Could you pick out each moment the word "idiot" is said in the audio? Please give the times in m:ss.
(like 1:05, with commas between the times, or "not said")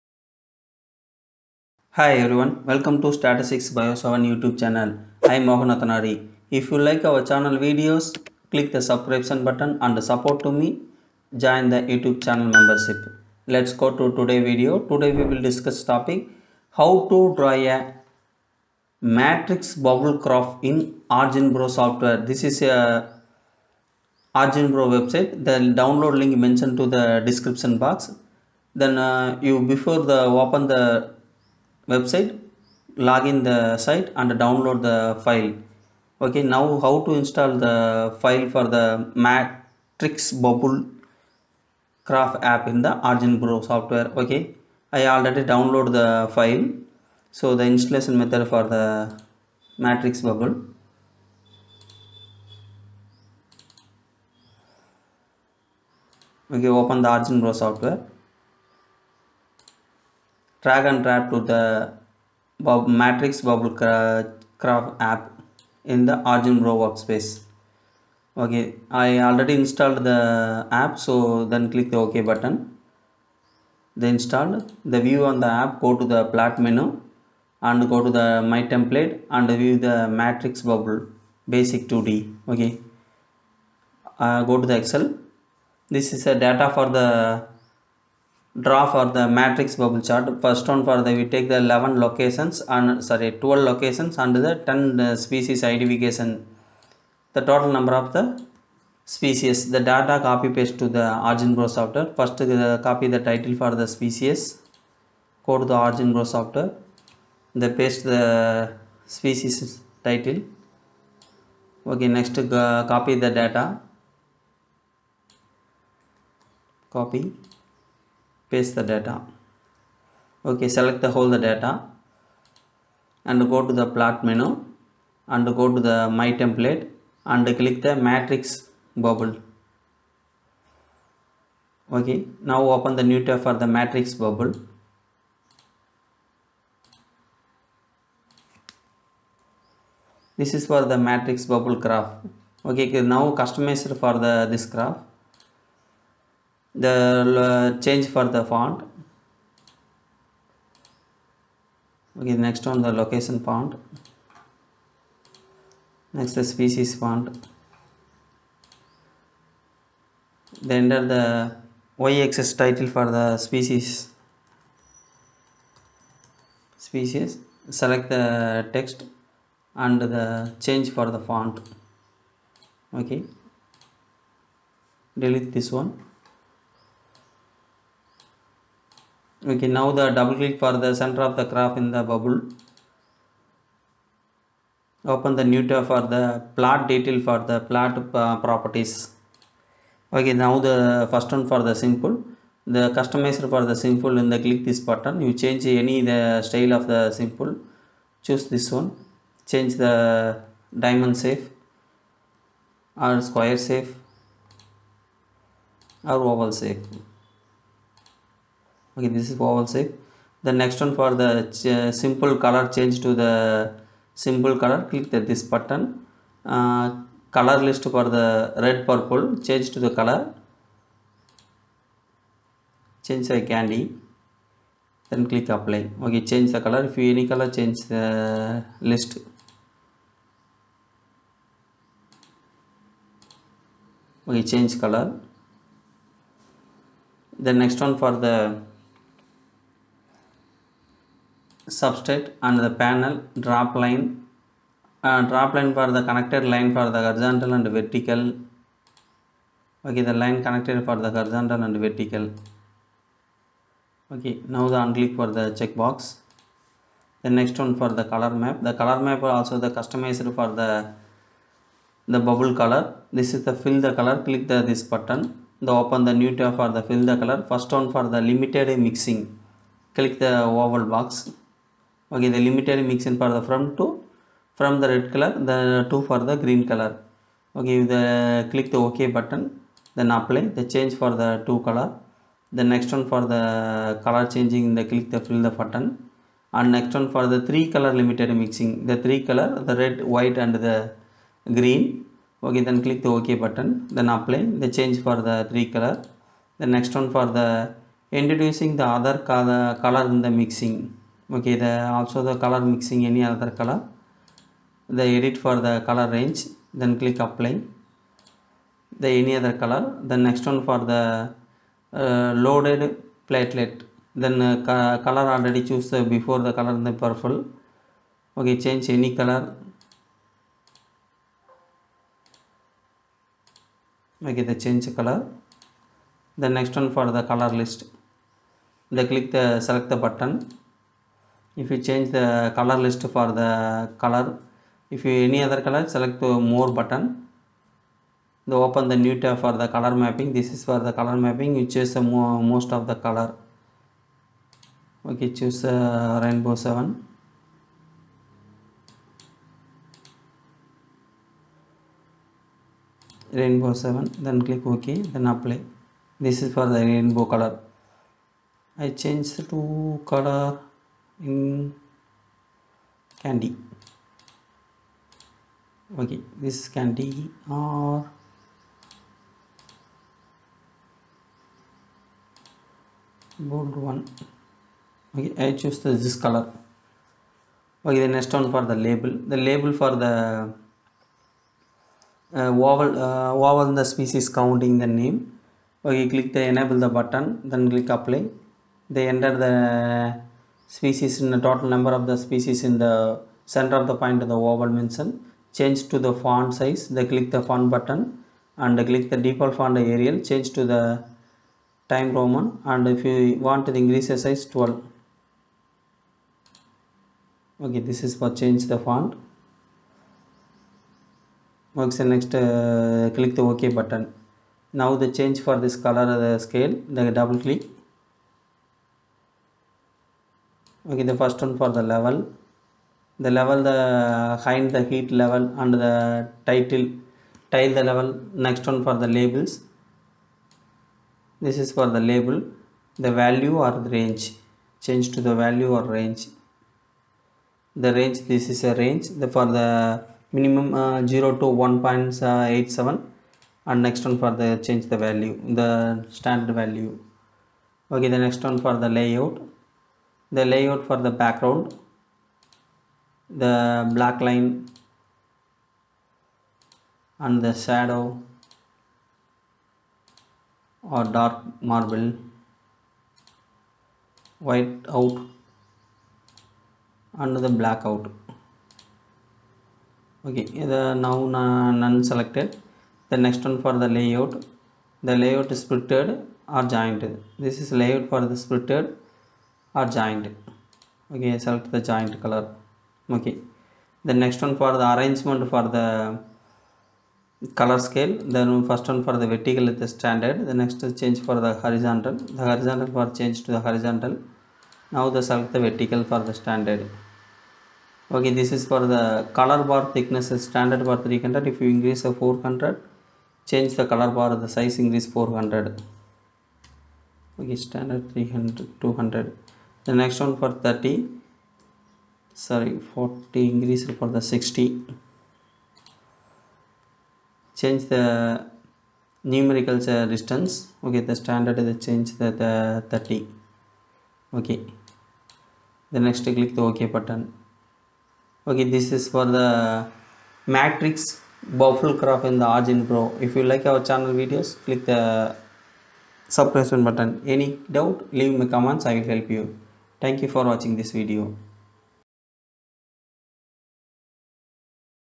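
not said.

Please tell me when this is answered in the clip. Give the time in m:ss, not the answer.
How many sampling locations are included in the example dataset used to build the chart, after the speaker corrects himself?
1:33.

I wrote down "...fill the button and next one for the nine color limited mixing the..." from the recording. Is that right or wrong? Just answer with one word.
wrong.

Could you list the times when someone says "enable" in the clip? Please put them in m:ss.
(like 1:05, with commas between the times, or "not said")
6:26.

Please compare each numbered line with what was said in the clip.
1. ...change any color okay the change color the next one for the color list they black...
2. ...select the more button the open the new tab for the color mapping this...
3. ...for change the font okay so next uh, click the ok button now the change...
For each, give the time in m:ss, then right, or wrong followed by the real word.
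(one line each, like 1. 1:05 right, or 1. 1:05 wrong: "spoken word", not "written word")
1. 5:18 wrong: "click", not "black"
2. 5:35 right
3. 6:48 right.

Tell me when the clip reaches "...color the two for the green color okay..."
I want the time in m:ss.
4:35.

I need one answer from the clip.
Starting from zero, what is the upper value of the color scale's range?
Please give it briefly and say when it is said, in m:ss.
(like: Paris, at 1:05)
1.87, at 7:21.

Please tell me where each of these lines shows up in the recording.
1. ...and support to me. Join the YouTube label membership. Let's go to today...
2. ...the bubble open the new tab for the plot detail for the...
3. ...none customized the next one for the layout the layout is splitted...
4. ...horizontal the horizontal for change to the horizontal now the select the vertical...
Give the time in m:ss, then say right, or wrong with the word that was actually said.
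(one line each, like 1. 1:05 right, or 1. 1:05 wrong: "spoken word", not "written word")
1. 0:09 wrong: "channel", not "label"
2. 3:01 right
3. 7:51 wrong: "selected", not "customized"
4. 8:11 right.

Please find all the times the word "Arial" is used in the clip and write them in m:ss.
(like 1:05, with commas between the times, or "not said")
6:39.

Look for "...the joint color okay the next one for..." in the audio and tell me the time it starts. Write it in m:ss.
8:01.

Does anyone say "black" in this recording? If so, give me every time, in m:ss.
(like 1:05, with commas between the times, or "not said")
7:33, 7:47.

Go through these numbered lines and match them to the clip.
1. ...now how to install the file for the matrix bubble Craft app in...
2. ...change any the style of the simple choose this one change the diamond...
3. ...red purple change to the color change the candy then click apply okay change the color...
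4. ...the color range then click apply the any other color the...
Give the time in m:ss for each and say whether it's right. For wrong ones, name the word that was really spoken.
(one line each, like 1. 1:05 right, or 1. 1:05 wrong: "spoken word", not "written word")
1. 0:36 right
2. 3:15 right
3. 3:38 right
4. 5:05 right.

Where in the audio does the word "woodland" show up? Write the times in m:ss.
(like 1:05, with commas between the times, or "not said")
not said.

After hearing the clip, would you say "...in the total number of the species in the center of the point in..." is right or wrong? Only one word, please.
right.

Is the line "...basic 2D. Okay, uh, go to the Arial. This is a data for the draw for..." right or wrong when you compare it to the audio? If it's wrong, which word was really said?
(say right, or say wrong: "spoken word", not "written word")
wrong: "Excel", not "Arial".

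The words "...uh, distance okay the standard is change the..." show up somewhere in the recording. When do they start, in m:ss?
8:39.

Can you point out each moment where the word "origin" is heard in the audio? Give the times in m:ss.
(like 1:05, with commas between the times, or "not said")
0:43, 0:57, 1:06, 1:41, 1:45, 8:52.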